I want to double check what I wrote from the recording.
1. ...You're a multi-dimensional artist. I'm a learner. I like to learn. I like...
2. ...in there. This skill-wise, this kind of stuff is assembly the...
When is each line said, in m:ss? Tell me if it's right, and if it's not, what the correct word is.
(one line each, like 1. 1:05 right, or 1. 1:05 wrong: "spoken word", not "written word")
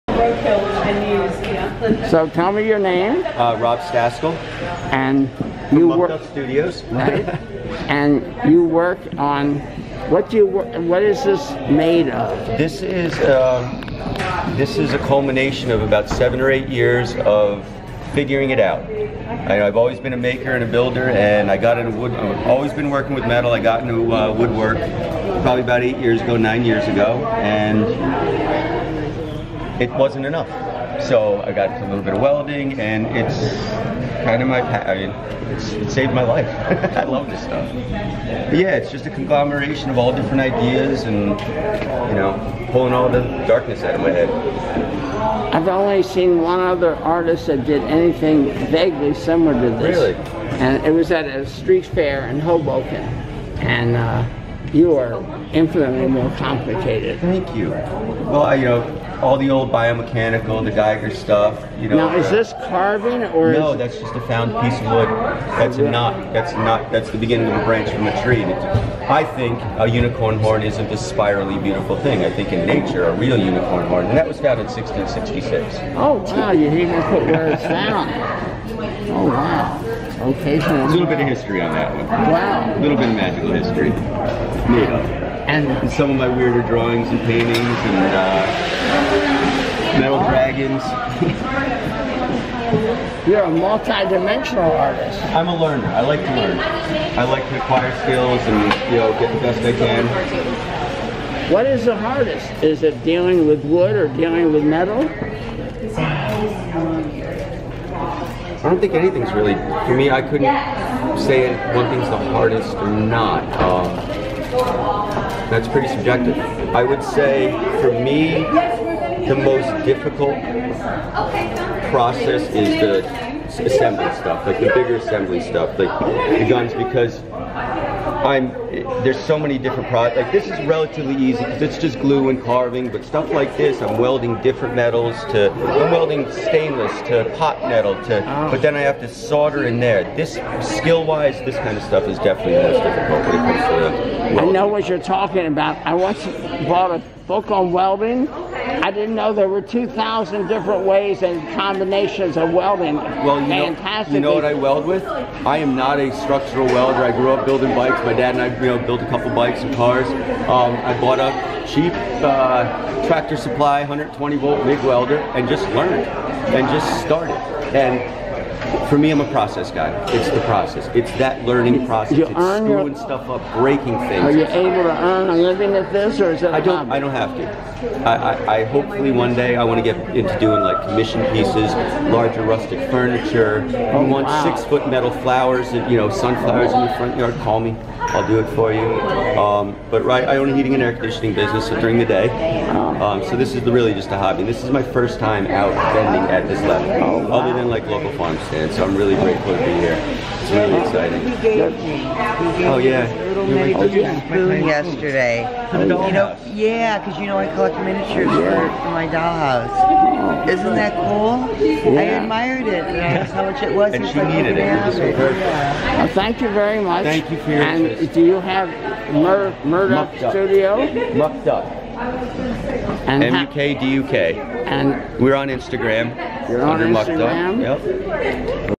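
1. 1:33 right
2. 2:19 wrong: "definitely", not "assembly".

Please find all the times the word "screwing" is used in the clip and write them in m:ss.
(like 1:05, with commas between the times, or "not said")
2:52.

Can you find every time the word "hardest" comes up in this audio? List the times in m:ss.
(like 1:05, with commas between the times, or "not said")
1:41, 1:52.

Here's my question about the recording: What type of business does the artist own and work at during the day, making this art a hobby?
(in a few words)
Heating and air conditioning.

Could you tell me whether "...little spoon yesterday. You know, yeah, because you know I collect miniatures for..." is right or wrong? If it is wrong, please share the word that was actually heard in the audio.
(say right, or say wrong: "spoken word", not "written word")
right.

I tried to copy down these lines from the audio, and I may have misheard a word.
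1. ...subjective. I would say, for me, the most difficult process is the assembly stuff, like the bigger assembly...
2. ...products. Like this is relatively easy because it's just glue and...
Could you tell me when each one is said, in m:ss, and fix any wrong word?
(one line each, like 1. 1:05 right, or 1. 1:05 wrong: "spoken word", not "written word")
1. 1:55 right
2. 2:09 right.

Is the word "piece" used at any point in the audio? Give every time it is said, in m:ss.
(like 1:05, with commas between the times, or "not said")
1:04, 3:01.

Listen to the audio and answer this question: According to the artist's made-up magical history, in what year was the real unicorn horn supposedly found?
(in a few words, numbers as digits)
1666.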